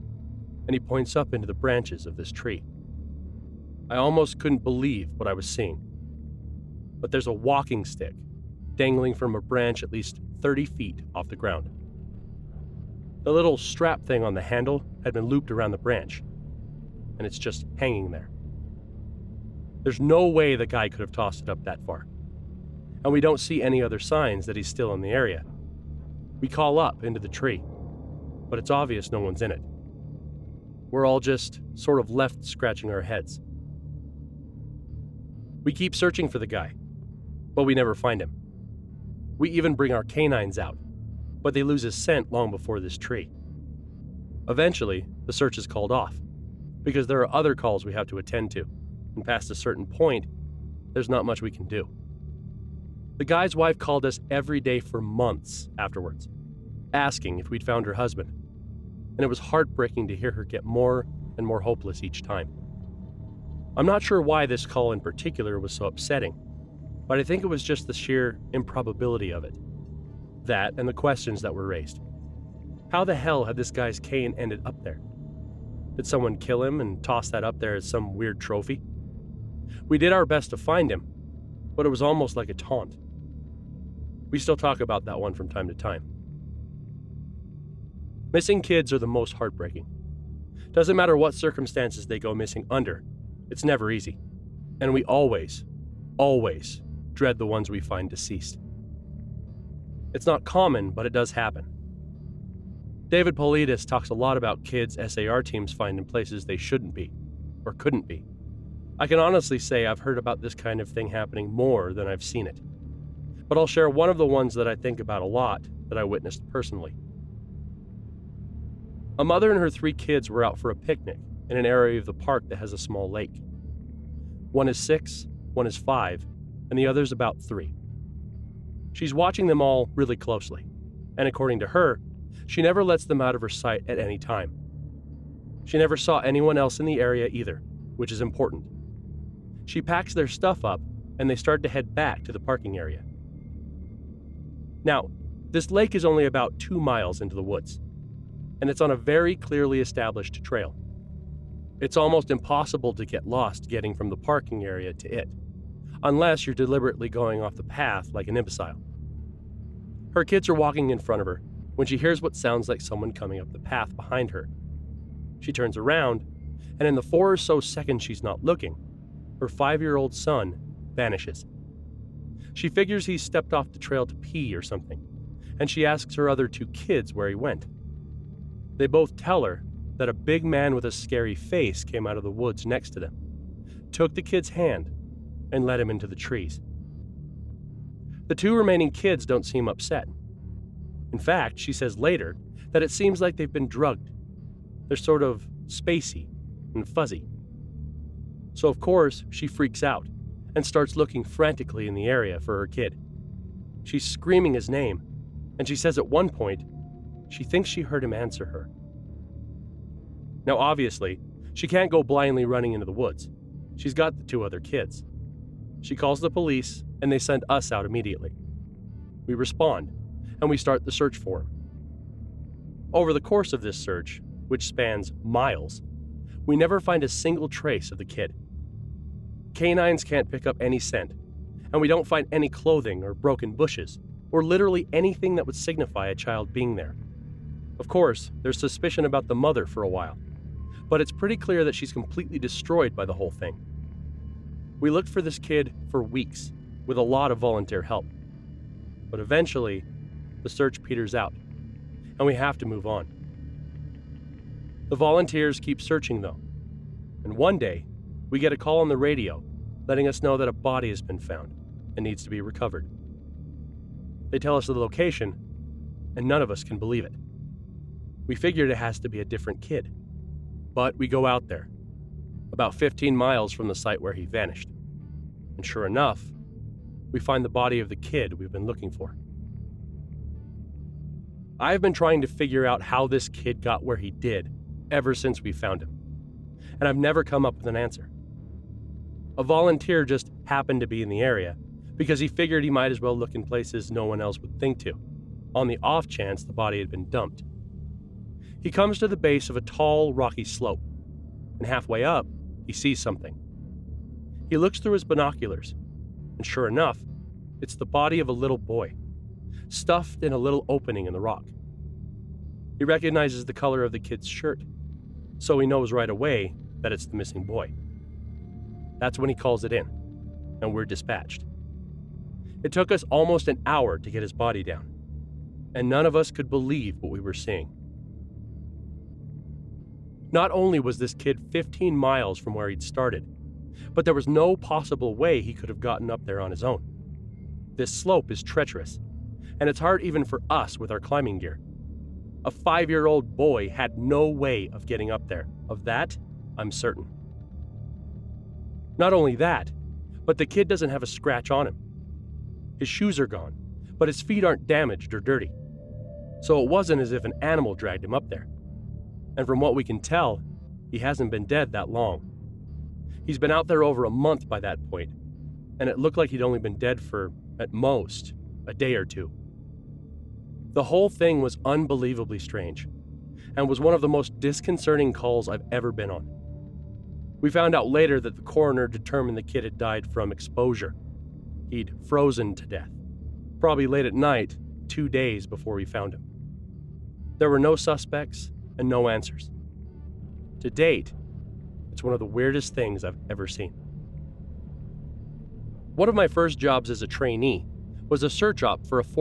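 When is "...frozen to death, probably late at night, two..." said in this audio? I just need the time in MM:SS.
06:22.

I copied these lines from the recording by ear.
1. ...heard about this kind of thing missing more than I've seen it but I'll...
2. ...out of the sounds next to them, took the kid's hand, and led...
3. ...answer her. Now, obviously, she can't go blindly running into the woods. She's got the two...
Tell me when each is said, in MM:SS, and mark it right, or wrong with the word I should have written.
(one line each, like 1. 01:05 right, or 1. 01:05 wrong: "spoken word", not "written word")
1. 01:49 wrong: "happening", not "missing"
2. 03:02 wrong: "woods", not "sounds"
3. 03:28 right.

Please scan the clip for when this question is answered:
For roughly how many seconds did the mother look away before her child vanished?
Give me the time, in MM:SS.
02:47.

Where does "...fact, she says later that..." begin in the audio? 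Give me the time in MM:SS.
03:11.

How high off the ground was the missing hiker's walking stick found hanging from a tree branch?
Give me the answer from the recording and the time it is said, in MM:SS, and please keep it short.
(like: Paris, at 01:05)
30 feet, at 00:10.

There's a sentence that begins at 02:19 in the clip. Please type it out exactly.
She packs their stuff up and they start to head back to the parking area.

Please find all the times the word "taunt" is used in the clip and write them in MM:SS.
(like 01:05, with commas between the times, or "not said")
01:22.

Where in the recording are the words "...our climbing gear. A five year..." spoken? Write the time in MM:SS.
05:40.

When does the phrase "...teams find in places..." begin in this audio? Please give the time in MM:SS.
01:45.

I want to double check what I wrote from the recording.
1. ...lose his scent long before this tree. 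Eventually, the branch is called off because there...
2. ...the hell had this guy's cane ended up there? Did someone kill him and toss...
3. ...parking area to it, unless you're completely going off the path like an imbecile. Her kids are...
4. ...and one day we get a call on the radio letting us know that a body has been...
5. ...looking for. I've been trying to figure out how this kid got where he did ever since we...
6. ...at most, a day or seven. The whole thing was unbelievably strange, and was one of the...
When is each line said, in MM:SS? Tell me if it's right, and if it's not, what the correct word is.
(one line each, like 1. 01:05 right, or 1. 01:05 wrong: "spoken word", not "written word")
1. 00:41 wrong: "search", not "branch"
2. 01:13 right
3. 02:34 wrong: "deliberately", not "completely"
4. 04:17 right
5. 04:38 right
6. 06:07 wrong: "two", not "seven".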